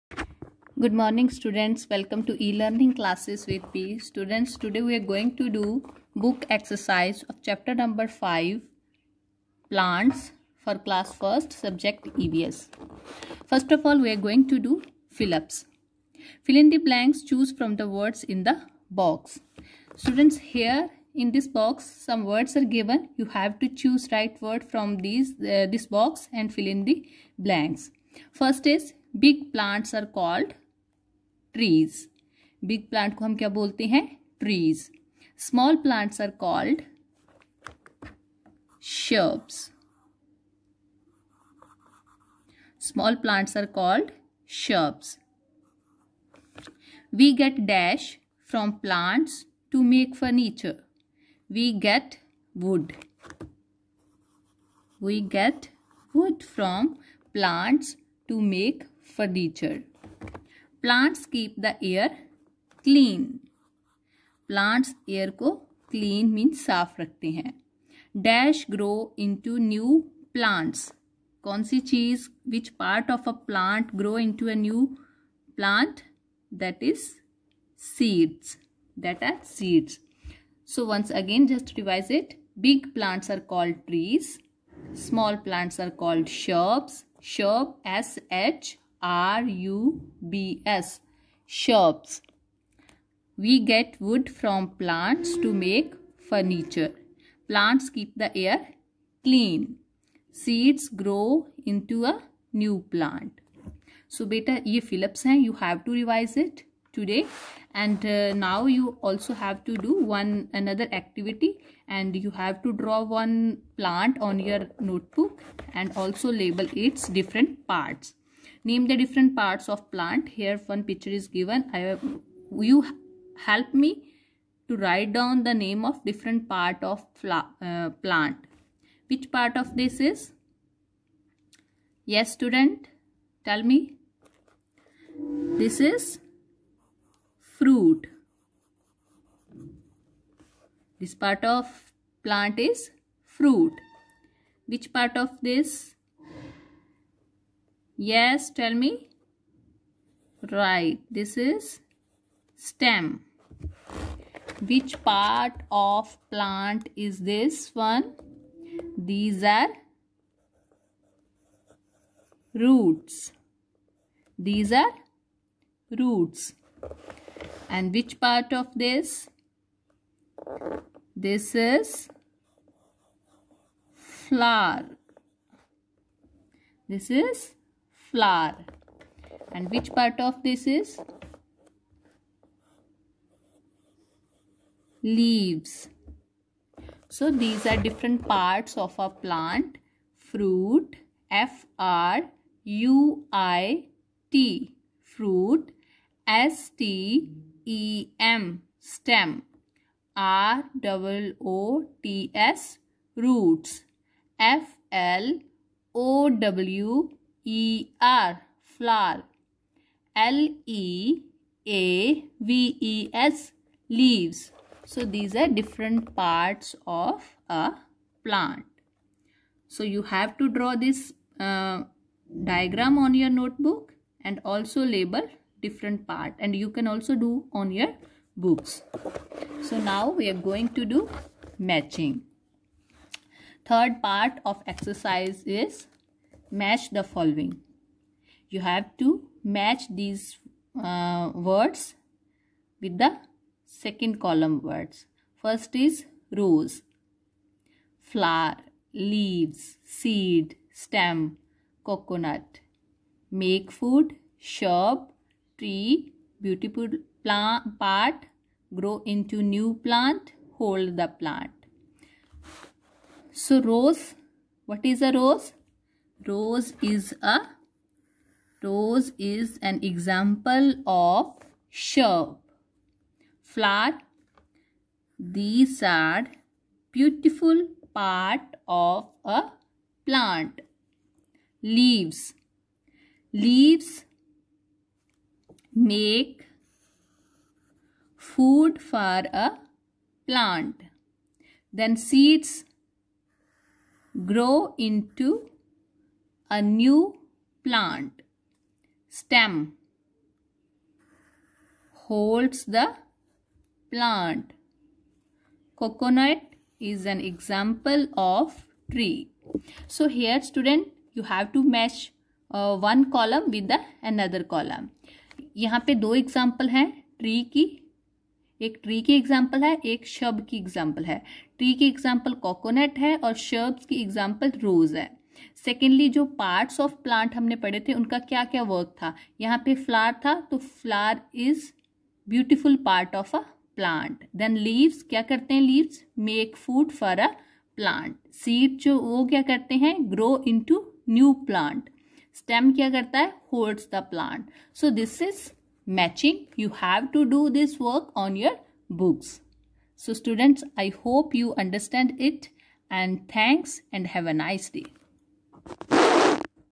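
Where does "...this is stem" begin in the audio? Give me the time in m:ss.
2:31.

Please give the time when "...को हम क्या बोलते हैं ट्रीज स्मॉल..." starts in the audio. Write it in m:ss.
0:33.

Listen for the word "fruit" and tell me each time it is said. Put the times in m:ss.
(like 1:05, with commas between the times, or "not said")
2:17, 2:23, 3:10, 3:15.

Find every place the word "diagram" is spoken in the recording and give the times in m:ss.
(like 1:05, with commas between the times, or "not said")
3:42.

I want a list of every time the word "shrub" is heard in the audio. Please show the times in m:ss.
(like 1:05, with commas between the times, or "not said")
1:31, 4:14, 4:31.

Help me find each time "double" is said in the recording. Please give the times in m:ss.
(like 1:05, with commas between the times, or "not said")
3:20.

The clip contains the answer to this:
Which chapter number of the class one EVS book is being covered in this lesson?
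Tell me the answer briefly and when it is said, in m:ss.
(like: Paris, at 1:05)
5, at 0:07.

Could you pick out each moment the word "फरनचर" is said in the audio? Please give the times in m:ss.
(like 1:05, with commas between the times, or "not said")
0:50, 0:59.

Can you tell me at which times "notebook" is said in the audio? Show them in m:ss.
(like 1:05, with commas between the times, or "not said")
1:54, 3:43.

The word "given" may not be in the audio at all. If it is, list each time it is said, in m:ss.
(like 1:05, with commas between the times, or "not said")
0:22, 2:01.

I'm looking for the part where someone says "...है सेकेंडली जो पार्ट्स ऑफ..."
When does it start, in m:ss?
5:24.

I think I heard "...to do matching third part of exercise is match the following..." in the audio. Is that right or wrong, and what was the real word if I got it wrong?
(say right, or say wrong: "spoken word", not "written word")
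right.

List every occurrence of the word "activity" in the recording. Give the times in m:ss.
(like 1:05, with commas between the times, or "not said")
1:50.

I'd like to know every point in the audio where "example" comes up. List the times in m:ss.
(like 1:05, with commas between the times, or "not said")
4:29, 5:07, 5:16.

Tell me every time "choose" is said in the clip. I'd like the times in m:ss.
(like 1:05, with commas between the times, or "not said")
0:17, 0:23.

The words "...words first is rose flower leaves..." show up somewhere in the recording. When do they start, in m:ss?
4:04.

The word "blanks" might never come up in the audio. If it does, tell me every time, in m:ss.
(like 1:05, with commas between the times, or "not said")
0:16, 0:27.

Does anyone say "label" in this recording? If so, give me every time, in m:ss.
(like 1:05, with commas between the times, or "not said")
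1:56, 3:44.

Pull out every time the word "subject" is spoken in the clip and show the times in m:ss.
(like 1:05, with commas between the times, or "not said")
0:11.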